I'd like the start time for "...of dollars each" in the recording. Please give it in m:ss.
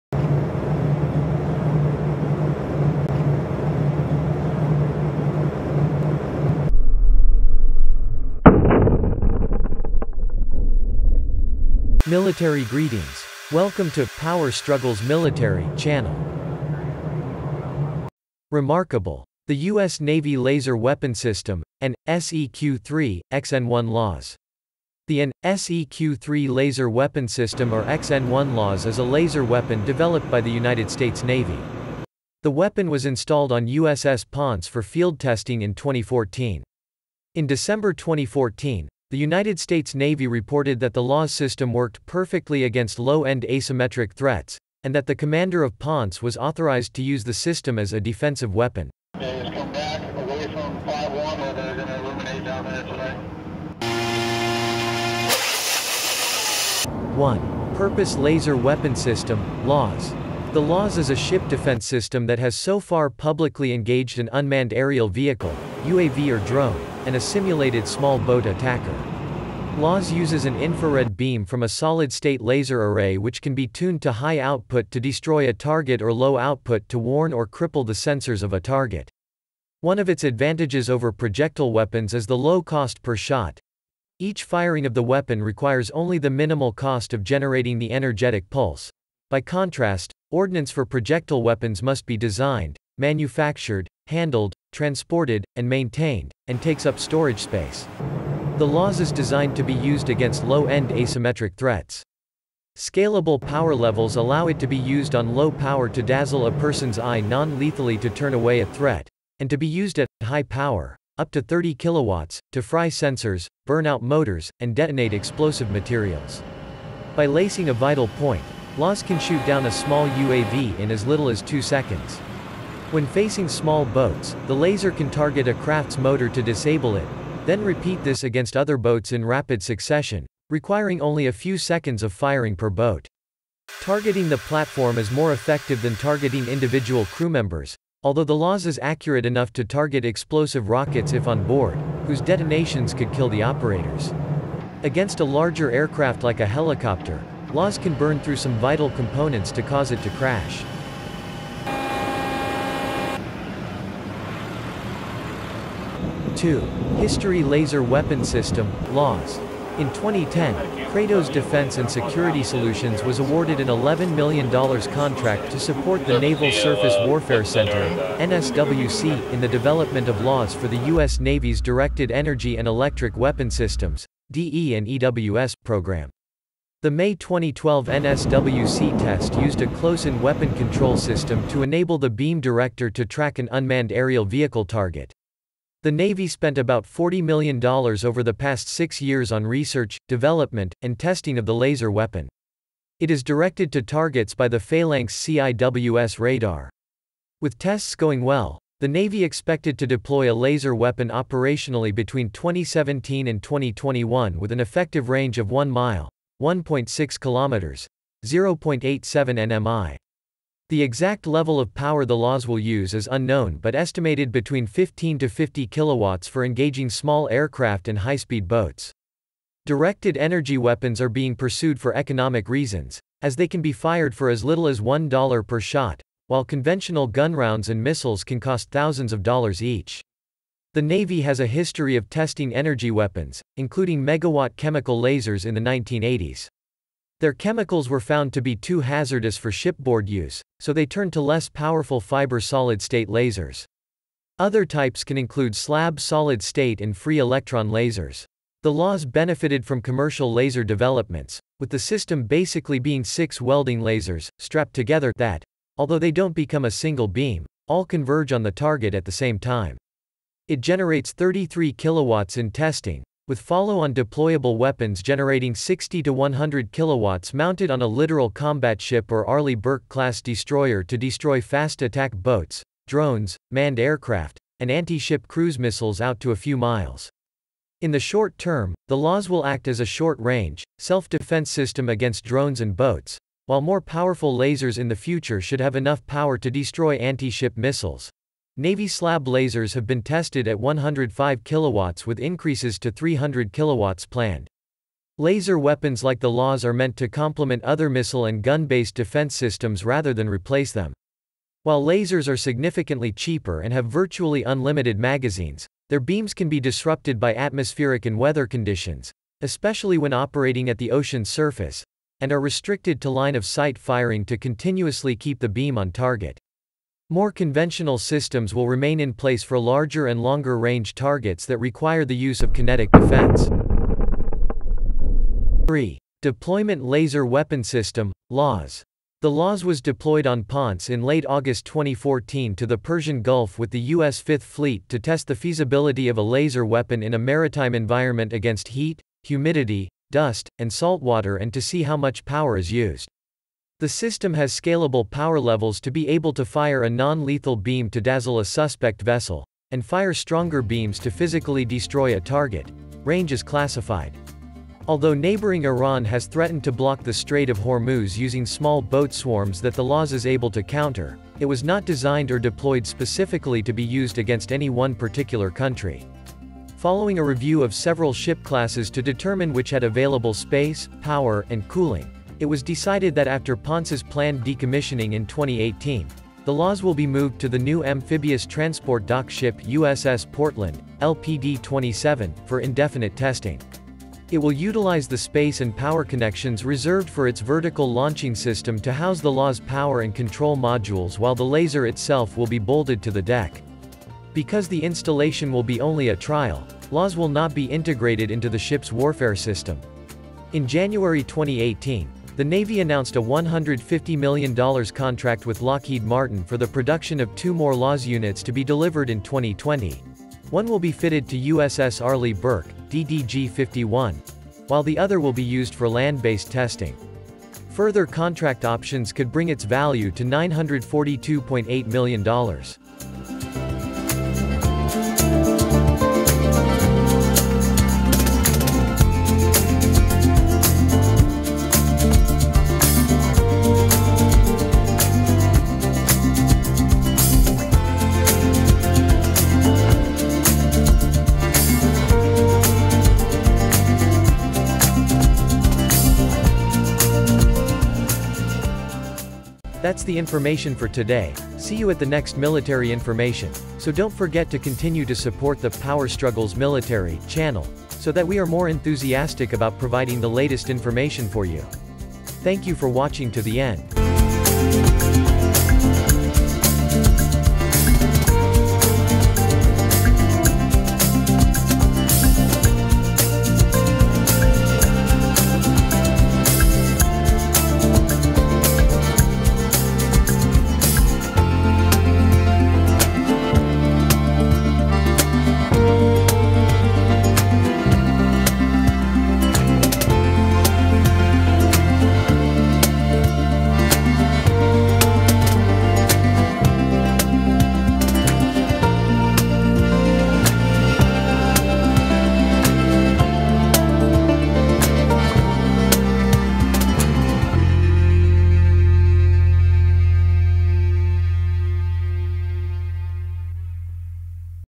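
3:49.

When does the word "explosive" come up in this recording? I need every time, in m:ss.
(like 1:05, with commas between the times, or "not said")
1:55, 2:20.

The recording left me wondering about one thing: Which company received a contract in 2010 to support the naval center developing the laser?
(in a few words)
Kratos Defense and Security Solutions.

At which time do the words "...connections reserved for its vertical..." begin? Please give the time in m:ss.
6:26.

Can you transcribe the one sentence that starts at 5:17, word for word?
More conventional systems will remain in place for larger and longer range targets that require the use of kinetic defense.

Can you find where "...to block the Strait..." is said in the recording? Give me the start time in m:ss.
5:56.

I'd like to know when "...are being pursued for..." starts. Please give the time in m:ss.
3:41.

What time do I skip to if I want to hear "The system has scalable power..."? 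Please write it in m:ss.
5:43.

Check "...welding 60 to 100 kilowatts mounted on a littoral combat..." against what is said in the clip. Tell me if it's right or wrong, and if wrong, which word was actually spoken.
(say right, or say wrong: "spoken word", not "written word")
wrong: "generating", not "welding".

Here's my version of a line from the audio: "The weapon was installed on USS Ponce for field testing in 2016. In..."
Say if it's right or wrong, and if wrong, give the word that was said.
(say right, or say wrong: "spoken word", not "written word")
wrong: "2014", not "2016".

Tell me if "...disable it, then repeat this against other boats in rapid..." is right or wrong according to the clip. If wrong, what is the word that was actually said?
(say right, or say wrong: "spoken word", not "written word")
right.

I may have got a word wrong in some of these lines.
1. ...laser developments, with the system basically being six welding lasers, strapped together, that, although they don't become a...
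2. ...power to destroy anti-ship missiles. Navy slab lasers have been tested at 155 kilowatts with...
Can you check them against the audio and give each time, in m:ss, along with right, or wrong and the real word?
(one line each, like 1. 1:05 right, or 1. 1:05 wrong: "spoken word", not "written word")
1. 4:10 right
2. 4:46 wrong: "105", not "155".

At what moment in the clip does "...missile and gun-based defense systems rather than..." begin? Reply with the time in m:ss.
4:57.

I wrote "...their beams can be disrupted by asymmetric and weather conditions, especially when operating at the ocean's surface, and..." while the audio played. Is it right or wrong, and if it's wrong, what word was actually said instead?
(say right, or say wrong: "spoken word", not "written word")
wrong: "atmospheric", not "asymmetric".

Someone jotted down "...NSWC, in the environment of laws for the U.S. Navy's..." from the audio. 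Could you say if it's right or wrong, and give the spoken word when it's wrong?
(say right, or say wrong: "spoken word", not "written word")
wrong: "development", not "environment".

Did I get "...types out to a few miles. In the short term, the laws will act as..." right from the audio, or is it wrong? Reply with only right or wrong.
wrong.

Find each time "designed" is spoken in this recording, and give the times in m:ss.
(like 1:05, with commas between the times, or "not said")
1:32, 1:39, 6:01.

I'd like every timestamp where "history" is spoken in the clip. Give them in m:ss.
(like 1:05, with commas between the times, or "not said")
2:36, 3:51.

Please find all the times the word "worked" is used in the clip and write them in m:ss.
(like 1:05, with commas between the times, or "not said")
0:41.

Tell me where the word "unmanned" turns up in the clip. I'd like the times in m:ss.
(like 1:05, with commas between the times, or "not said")
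1:04, 3:03.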